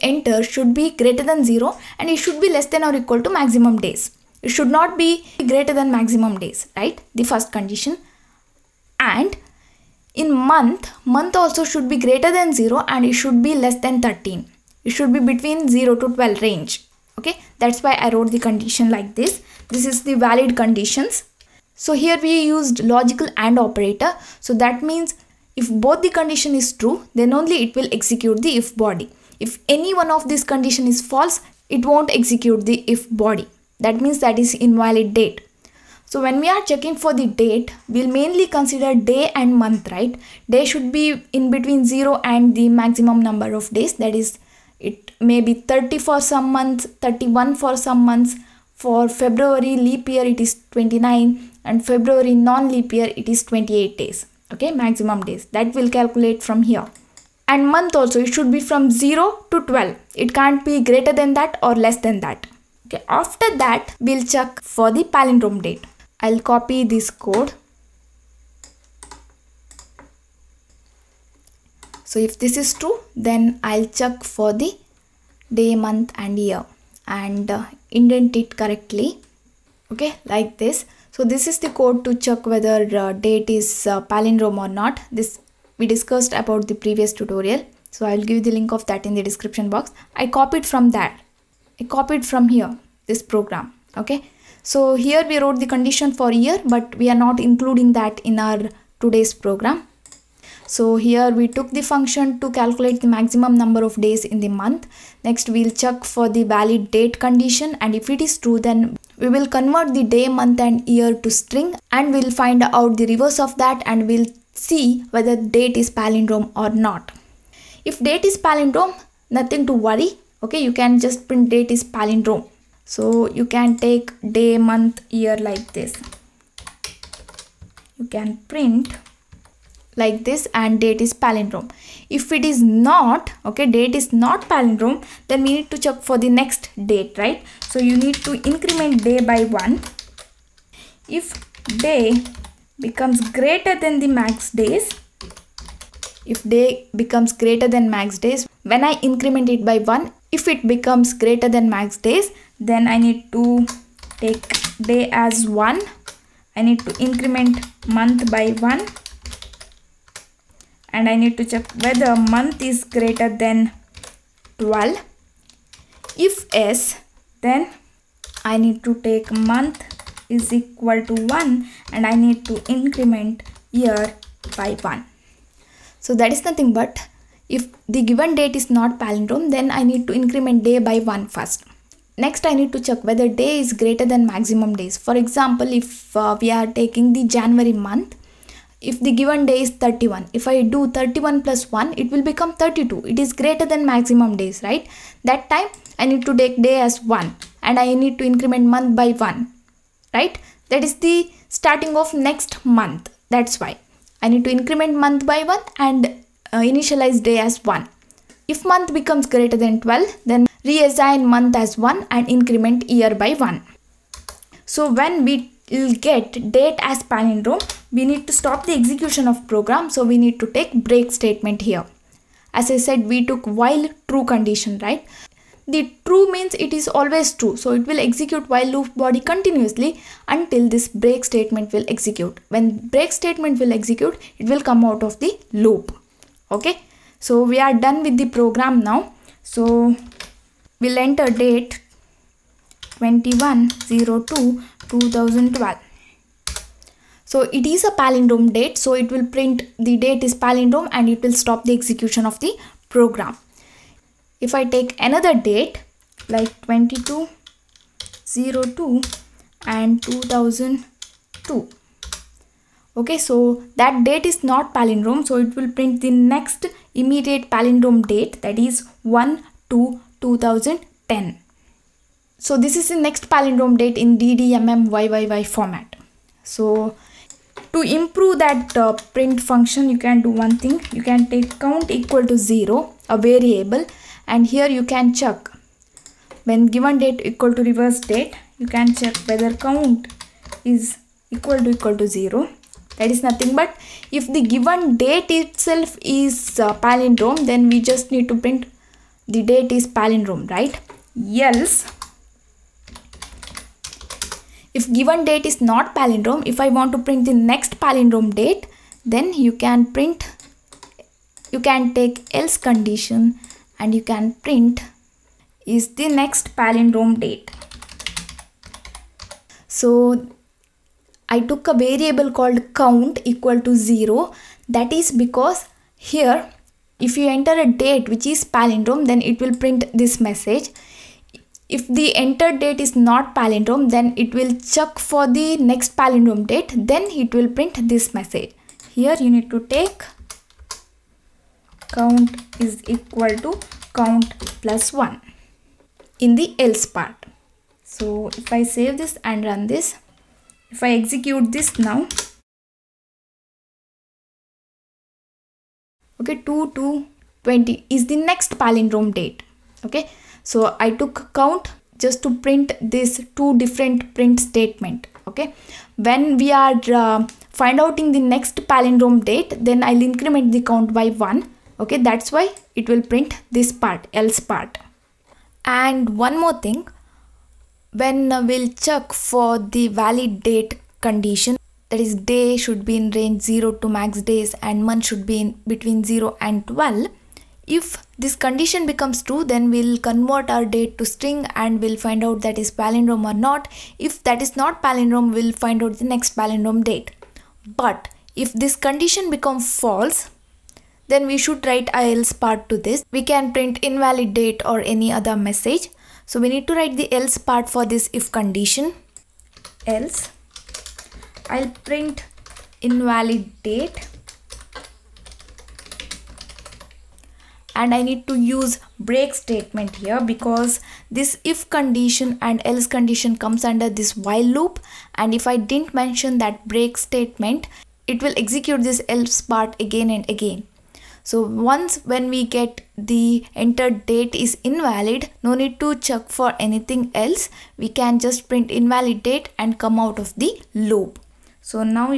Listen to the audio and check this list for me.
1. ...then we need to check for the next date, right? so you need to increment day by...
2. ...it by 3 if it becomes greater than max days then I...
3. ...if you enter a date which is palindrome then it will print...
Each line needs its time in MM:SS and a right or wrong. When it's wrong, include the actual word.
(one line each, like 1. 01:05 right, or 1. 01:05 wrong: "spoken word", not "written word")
1. 02:15 right
2. 02:29 wrong: "1", not "3"
3. 05:26 right.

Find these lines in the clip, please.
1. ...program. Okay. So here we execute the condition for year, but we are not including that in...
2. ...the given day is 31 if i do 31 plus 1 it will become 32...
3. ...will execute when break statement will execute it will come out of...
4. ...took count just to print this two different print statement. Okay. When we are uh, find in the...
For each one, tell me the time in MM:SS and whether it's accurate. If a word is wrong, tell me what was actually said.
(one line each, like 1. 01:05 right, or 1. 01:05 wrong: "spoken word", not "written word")
1. 01:33 wrong: "wrote", not "execute"
2. 03:09 right
3. 03:51 right
4. 06:00 right.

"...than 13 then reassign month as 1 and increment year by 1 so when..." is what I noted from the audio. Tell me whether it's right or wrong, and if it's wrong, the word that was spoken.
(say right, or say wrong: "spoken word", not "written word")
wrong: "12", not "13".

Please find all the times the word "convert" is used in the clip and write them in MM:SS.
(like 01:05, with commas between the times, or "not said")
01:49, 06:29.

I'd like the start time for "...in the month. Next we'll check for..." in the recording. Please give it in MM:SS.
01:44.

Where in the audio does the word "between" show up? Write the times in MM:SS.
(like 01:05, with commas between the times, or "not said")
00:15, 00:41, 06:25.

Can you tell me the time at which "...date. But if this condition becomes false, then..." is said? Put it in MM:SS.
06:36.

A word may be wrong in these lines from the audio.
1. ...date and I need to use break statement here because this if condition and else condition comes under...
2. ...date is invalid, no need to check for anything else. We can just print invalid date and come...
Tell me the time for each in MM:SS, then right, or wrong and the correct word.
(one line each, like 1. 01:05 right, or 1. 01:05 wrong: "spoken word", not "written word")
1. 06:53 right
2. 07:14 right.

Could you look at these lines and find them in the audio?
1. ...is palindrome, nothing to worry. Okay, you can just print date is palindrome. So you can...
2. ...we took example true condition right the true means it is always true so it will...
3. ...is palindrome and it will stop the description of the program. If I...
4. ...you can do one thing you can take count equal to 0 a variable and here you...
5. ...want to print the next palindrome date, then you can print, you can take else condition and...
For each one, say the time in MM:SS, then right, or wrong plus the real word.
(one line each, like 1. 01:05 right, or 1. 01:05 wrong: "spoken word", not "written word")
1. 01:58 right
2. 03:43 wrong: "while", not "example"
3. 04:10 wrong: "execution", not "description"
4. 04:39 right
5. 05:06 right.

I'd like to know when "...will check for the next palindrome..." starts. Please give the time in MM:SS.
05:34.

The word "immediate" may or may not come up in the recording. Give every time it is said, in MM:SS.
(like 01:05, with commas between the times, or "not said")
04:27.